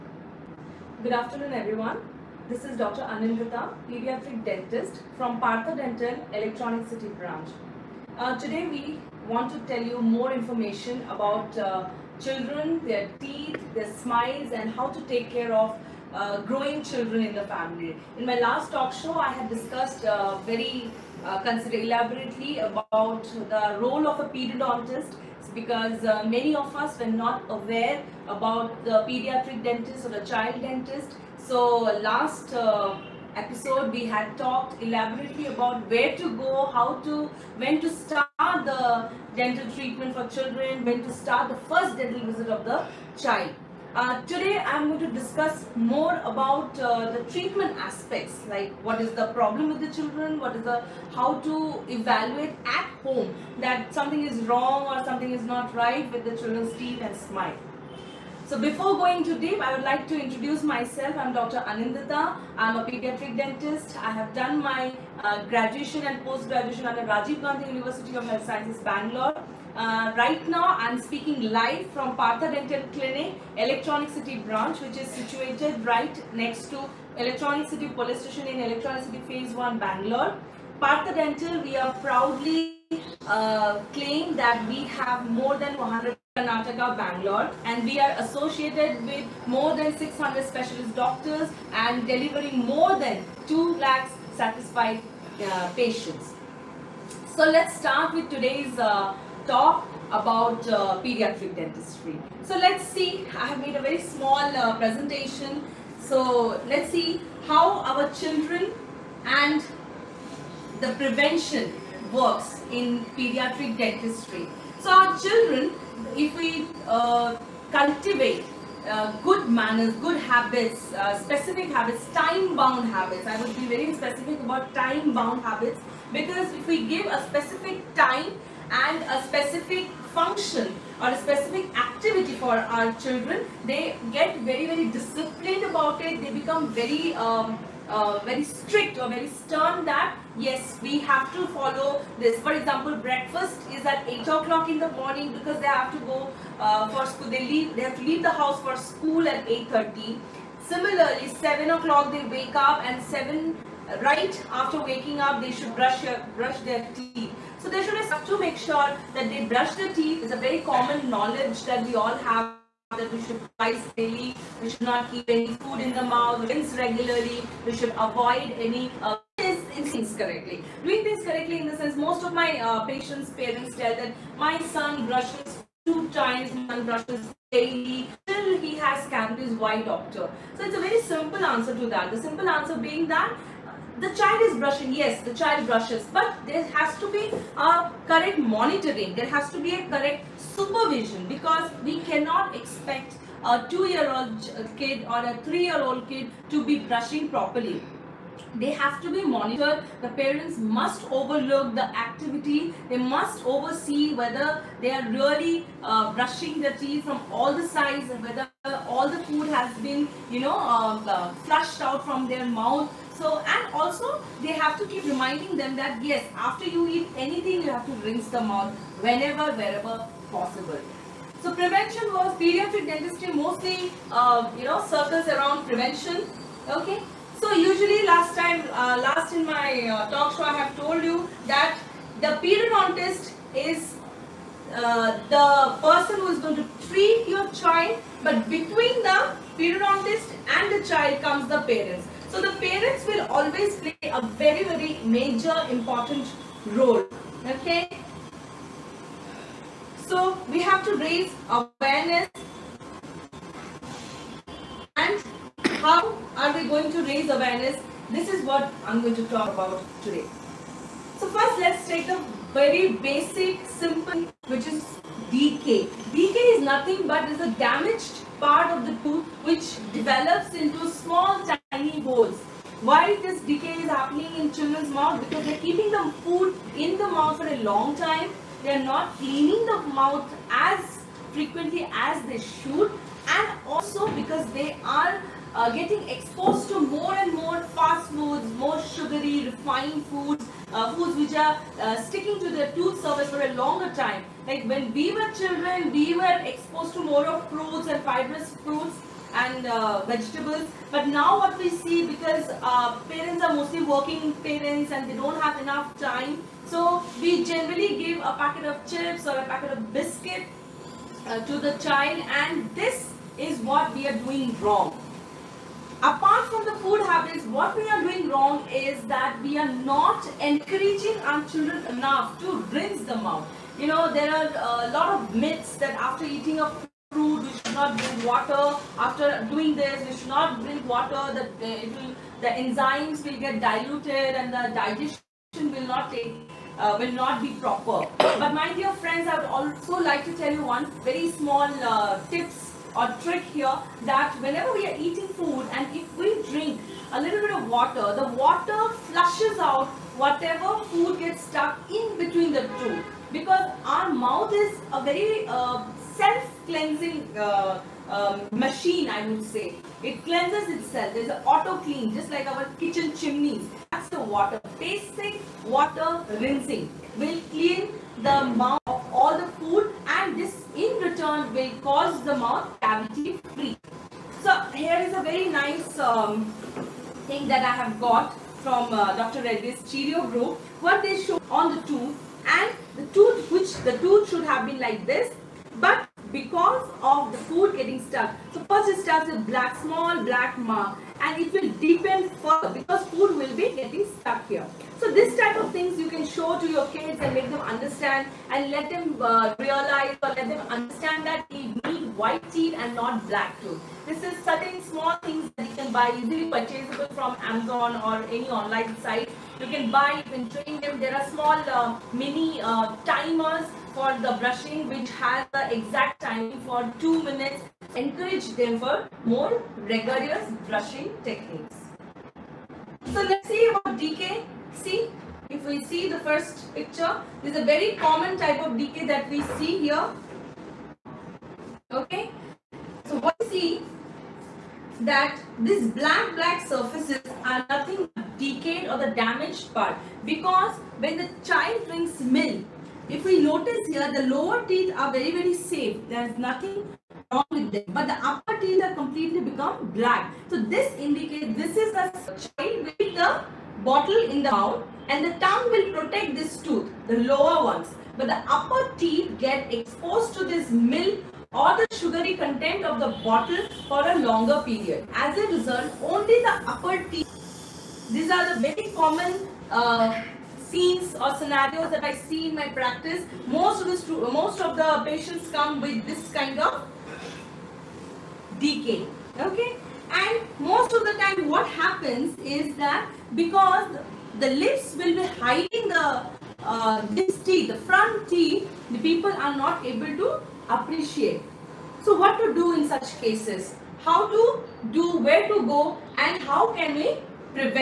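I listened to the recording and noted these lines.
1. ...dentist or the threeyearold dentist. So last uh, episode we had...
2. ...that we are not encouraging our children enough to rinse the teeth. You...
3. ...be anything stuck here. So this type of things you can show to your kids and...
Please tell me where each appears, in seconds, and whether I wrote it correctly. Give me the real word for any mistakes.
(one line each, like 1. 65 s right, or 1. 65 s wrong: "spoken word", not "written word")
1. 29 s wrong: "child", not "threeyearold"
2. 319 s wrong: "mouth", not "teeth"
3. 393 s wrong: "getting", not "anything".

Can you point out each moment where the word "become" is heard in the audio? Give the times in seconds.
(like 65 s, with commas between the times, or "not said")
136 s, 449 s.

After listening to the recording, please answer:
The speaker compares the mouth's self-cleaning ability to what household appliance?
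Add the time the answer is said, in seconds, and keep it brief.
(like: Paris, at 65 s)
kitchen chimneys, at 362 s.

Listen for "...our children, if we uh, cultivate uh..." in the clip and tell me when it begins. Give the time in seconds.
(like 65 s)
114 s.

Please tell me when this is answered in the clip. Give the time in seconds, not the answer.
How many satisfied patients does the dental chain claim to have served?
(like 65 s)
93 s.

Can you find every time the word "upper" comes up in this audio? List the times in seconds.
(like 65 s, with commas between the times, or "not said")
448 s, 458 s, 466 s.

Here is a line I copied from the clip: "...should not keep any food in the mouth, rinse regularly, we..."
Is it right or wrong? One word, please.
right.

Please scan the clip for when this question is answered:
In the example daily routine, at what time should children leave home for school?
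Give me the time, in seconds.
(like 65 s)
149 s.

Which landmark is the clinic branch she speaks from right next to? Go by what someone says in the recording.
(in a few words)
Electronic City Police Station.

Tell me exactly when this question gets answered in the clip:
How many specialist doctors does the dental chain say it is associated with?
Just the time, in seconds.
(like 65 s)
89 s.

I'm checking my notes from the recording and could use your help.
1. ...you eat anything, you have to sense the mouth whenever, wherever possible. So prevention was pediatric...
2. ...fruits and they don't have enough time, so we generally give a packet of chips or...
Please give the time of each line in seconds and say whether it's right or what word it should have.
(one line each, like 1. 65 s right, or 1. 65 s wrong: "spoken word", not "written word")
1. 216 s wrong: "rinse", not "sense"
2. 304 s wrong: "parents", not "fruits".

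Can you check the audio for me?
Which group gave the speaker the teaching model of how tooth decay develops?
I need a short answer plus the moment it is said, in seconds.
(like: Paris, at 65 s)
Dr. Reddy's Cheerio group, at 379 s.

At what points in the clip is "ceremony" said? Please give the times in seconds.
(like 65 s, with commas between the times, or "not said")
not said.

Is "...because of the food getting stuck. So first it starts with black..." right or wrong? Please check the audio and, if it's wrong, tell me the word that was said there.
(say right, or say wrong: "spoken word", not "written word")
right.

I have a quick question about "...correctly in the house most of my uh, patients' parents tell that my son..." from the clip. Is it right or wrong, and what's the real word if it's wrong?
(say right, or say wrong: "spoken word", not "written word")
wrong: "sense", not "house".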